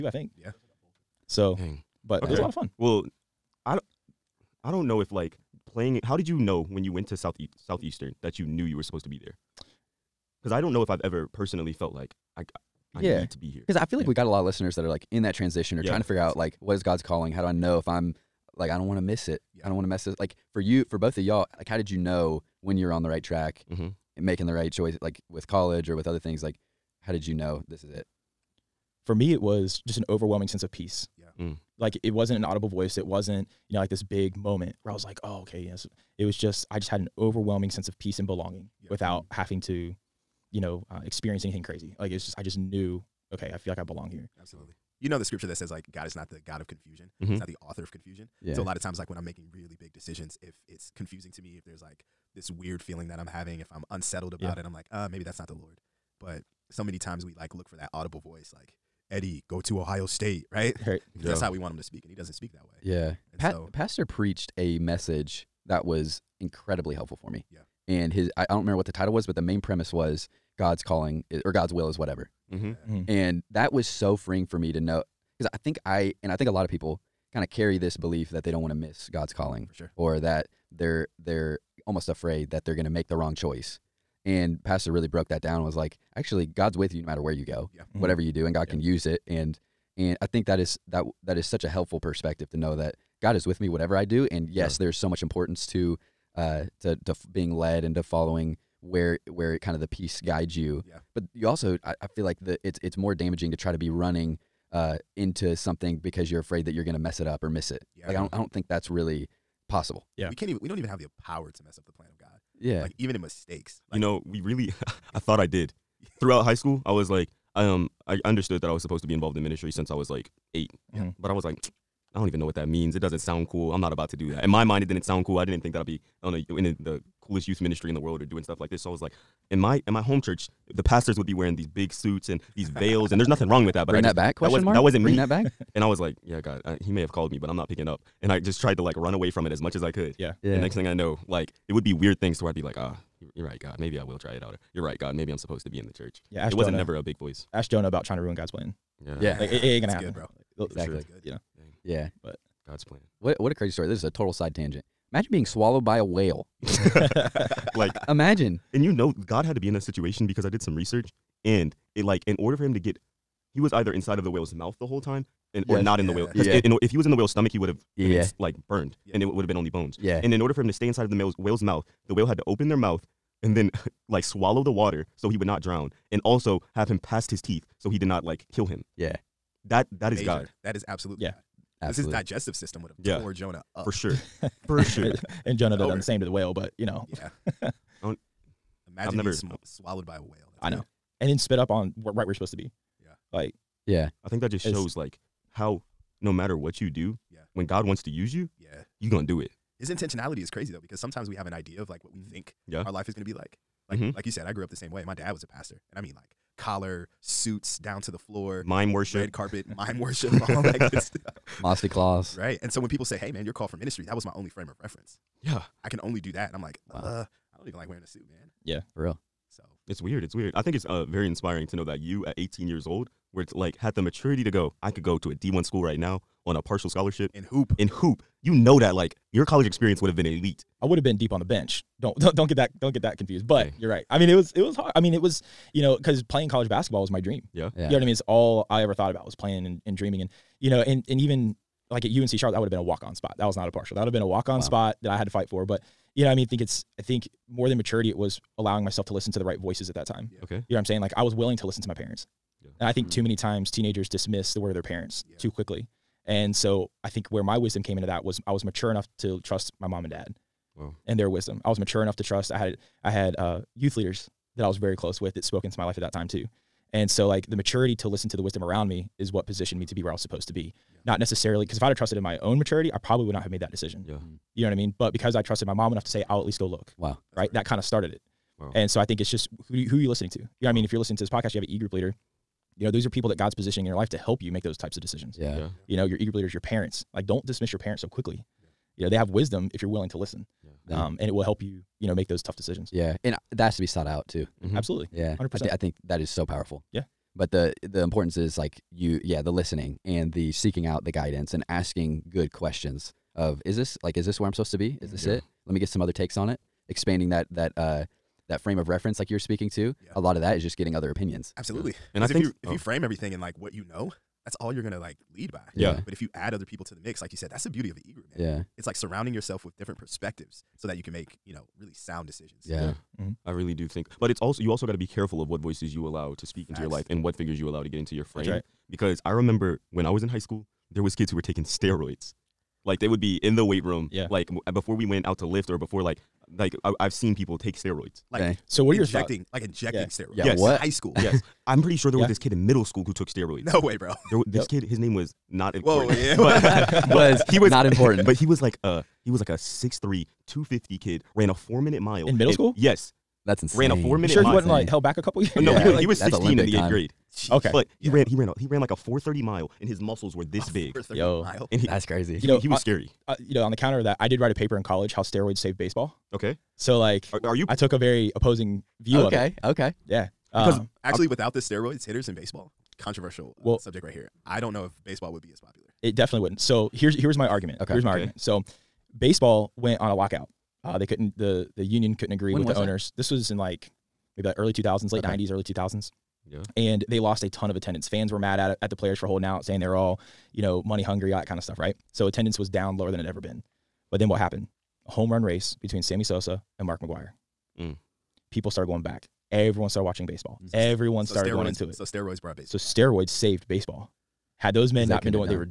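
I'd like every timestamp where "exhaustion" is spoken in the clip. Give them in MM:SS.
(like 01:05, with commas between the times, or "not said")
not said.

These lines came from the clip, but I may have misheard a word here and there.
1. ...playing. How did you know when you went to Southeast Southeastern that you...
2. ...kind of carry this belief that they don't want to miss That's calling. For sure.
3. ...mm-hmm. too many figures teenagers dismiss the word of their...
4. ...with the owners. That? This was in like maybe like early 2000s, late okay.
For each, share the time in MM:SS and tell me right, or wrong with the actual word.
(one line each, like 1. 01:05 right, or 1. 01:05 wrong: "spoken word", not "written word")
1. 00:05 right
2. 01:17 wrong: "God", not "That"
3. 04:13 wrong: "times", not "figures"
4. 06:22 right.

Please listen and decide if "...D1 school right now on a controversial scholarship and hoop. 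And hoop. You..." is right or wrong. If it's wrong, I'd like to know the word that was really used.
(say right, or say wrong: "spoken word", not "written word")
wrong: "partial", not "controversial".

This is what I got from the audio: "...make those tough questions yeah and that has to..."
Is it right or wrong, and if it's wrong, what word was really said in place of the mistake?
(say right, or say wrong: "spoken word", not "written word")
wrong: "decisions", not "questions".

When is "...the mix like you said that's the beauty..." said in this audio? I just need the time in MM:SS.
05:16.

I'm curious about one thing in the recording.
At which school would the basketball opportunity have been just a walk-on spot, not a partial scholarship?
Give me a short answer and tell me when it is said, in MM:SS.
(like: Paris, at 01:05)
UNC Charlotte, at 04:02.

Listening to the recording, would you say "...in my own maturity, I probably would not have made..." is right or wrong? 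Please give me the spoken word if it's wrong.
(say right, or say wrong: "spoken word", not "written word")
right.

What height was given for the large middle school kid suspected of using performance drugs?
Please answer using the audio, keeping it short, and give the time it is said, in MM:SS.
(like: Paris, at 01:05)
6'3", at 05:49.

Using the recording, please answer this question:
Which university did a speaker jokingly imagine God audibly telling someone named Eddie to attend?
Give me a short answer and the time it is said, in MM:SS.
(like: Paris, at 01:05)
Ohio State, at 00:59.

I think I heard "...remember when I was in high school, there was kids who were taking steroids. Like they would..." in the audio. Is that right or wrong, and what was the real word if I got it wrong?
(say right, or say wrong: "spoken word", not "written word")
right.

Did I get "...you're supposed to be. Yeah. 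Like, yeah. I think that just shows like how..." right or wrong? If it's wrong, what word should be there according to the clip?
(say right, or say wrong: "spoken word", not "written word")
right.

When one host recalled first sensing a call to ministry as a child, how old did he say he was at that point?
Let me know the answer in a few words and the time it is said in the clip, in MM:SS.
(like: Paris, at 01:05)
8, at 01:59.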